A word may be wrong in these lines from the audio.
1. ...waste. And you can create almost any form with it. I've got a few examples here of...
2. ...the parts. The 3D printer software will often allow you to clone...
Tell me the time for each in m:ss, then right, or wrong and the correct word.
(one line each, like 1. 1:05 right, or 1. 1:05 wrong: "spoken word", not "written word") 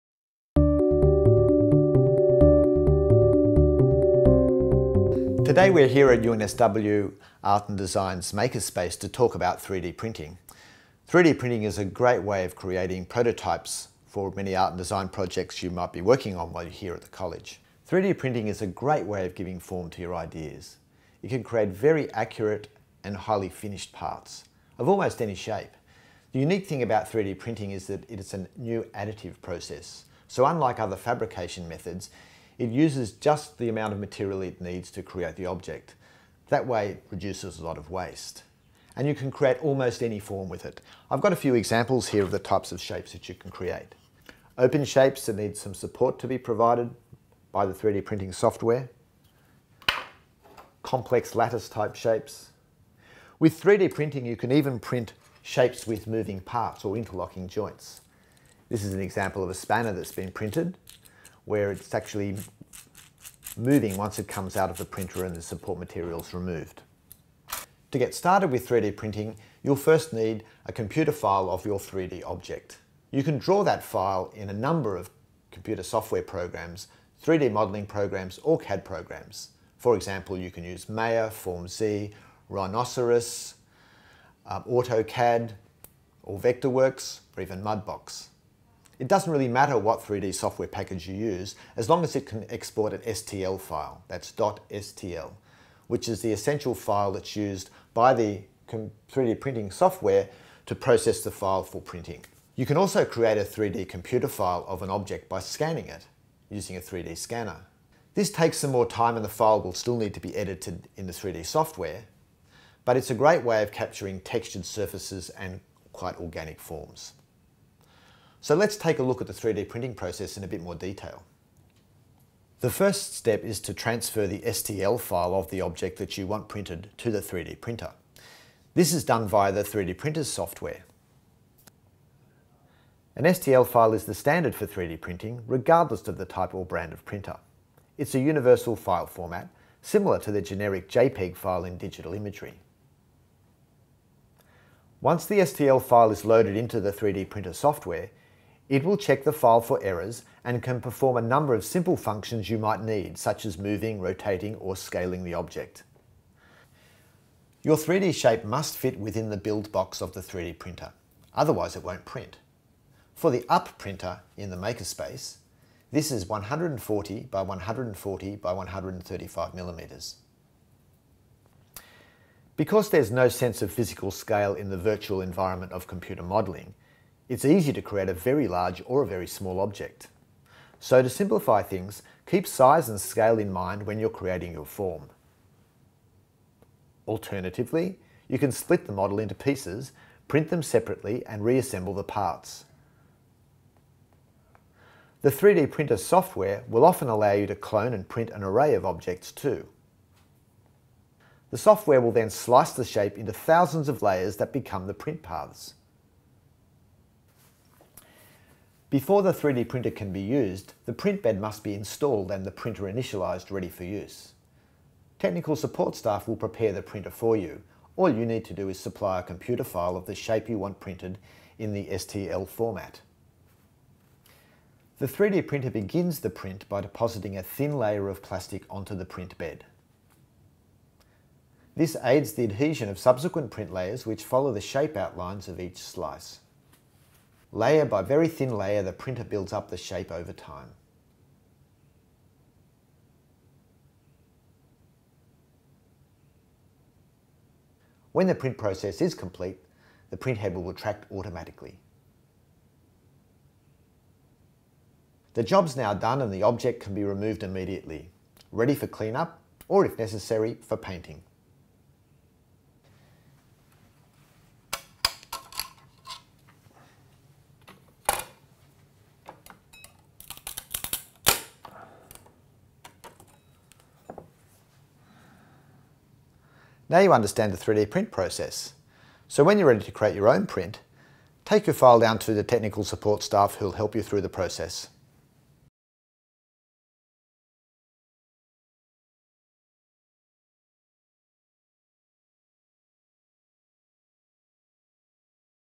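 1. 0:37 right
2. 3:11 right.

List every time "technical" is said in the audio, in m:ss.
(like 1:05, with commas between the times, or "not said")
3:35, 4:42.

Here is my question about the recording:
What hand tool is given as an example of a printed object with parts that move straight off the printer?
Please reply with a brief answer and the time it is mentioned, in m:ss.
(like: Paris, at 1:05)
Spanner, at 0:59.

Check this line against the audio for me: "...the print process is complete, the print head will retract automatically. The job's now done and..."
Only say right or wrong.
right.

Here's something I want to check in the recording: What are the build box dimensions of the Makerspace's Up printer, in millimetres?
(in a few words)
140 by 140 by 135.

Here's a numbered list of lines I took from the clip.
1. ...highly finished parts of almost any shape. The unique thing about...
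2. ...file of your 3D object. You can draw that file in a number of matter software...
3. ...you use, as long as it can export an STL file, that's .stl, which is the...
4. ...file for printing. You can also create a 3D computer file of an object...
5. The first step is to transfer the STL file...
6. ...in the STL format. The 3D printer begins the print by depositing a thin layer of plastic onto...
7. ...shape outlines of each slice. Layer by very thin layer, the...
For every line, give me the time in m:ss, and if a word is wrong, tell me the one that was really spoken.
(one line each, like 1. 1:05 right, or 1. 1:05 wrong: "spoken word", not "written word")
1. 0:23 right
2. 1:11 wrong: "computer", not "matter"
3. 1:31 right
4. 1:41 right
5. 2:02 right
6. 3:41 right
7. 3:54 right.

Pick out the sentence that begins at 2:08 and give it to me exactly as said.
This is done via the 3D printer's software.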